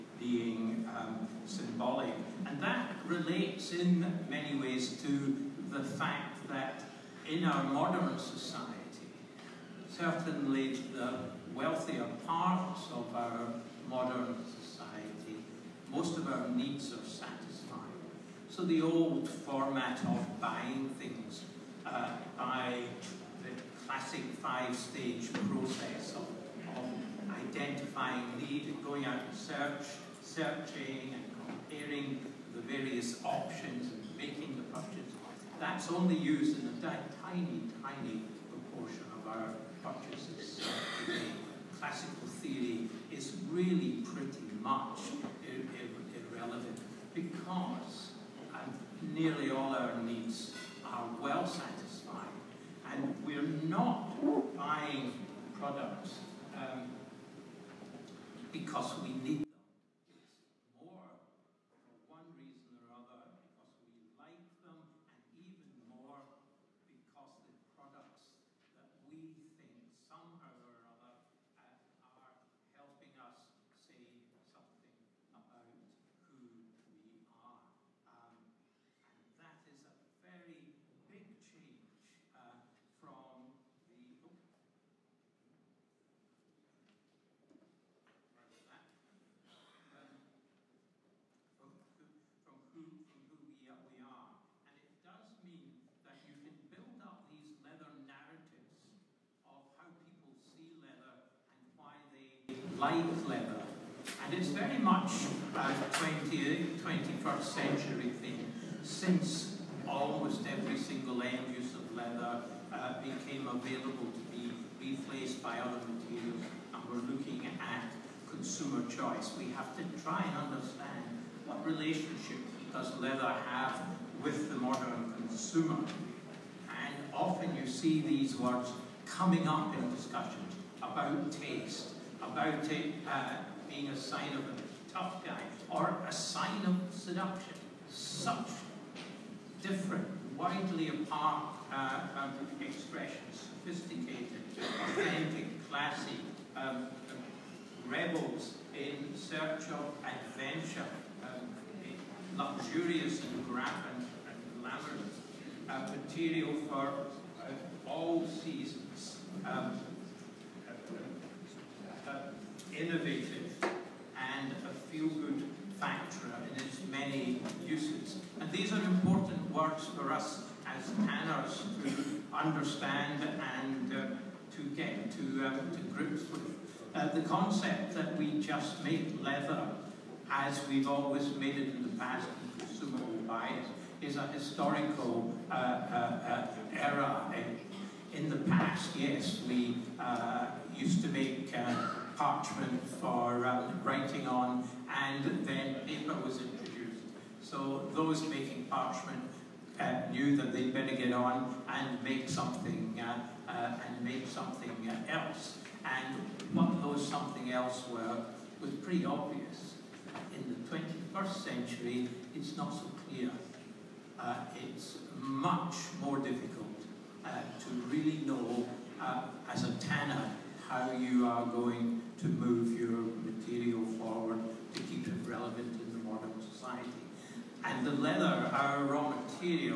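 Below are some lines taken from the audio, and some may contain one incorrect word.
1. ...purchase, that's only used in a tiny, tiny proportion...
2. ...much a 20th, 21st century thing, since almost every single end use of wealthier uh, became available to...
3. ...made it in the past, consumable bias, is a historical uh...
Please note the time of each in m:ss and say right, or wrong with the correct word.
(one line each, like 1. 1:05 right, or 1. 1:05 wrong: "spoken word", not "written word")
1. 0:34 right
2. 1:44 wrong: "leather", not "wealthier"
3. 3:01 right.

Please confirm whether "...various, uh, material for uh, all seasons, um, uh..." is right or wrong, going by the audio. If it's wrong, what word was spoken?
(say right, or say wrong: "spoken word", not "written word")
wrong: "glamorous", not "various".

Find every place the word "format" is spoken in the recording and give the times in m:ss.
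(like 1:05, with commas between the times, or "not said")
0:19.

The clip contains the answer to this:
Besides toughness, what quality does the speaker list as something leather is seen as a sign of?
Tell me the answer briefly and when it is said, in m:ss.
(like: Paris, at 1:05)
seduction, at 2:16.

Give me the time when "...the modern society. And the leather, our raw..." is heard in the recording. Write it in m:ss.
3:45.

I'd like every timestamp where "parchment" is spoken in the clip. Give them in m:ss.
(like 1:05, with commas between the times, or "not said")
3:12, 3:18.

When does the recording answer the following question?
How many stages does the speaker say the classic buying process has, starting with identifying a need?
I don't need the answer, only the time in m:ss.
0:24.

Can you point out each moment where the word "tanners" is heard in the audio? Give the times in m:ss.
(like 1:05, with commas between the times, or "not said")
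2:51, 3:39.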